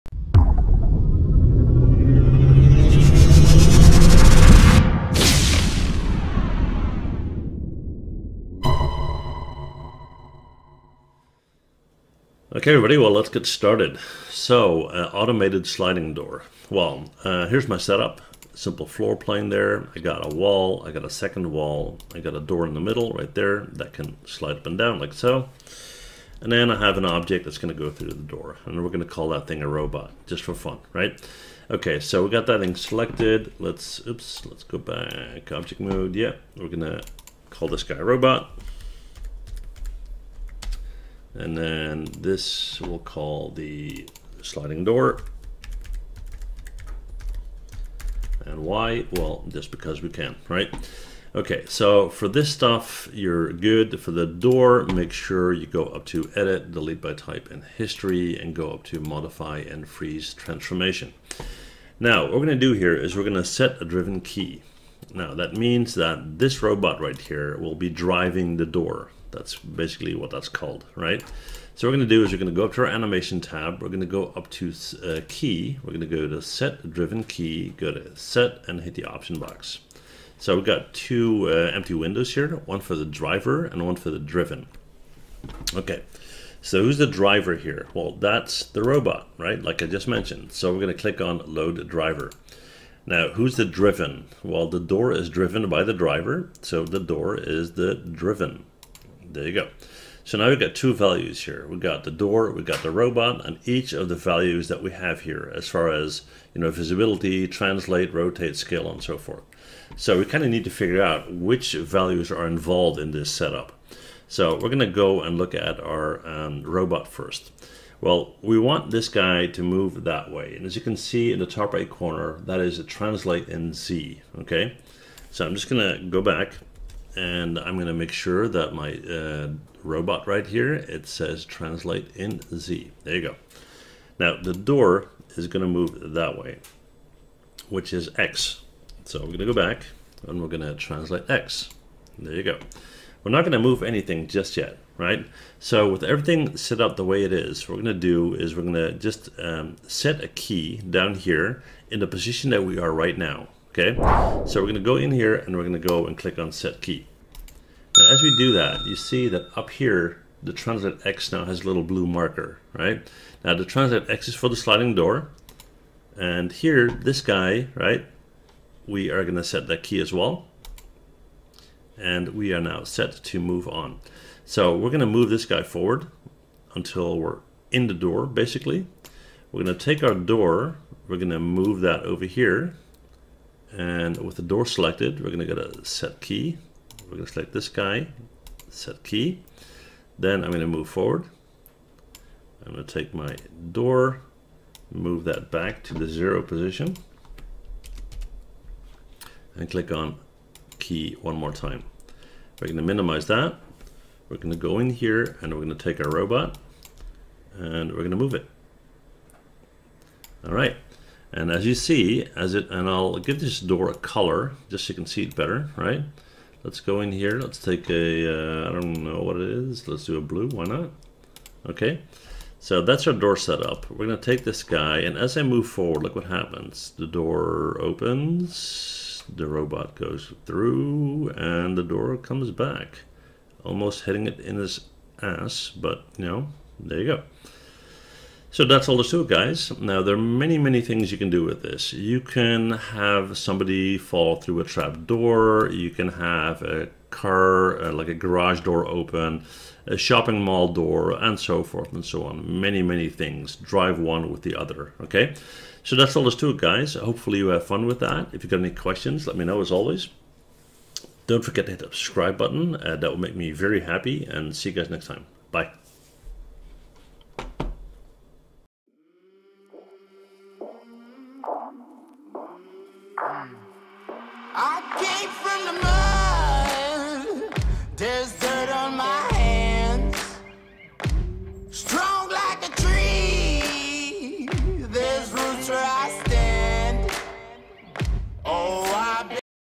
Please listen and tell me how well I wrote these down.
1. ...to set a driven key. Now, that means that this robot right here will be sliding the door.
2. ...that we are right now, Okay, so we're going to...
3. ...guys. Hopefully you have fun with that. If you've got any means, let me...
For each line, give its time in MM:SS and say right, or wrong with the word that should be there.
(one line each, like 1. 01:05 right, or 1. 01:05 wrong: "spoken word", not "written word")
1. 01:03 wrong: "driving", not "sliding"
2. 02:32 right
3. 04:16 wrong: "questions", not "means".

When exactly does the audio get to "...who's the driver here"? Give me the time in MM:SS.
01:26.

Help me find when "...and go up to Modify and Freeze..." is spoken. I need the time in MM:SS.
00:58.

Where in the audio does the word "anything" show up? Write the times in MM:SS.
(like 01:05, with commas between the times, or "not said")
02:23.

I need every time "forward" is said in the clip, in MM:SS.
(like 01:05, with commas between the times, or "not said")
02:55, 03:10, 03:45.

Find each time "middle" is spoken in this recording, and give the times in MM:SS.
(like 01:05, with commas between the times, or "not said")
00:22.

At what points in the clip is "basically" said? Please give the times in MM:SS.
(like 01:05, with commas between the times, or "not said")
01:09, 02:58.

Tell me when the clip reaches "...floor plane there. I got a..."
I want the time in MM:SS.
00:18.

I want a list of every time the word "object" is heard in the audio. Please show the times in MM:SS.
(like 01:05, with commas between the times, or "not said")
00:27, 00:35.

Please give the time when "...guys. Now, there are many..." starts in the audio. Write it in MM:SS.
03:59.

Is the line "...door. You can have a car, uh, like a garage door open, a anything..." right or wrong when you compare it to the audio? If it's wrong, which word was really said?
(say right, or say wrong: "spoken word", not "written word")
wrong: "shopping", not "anything".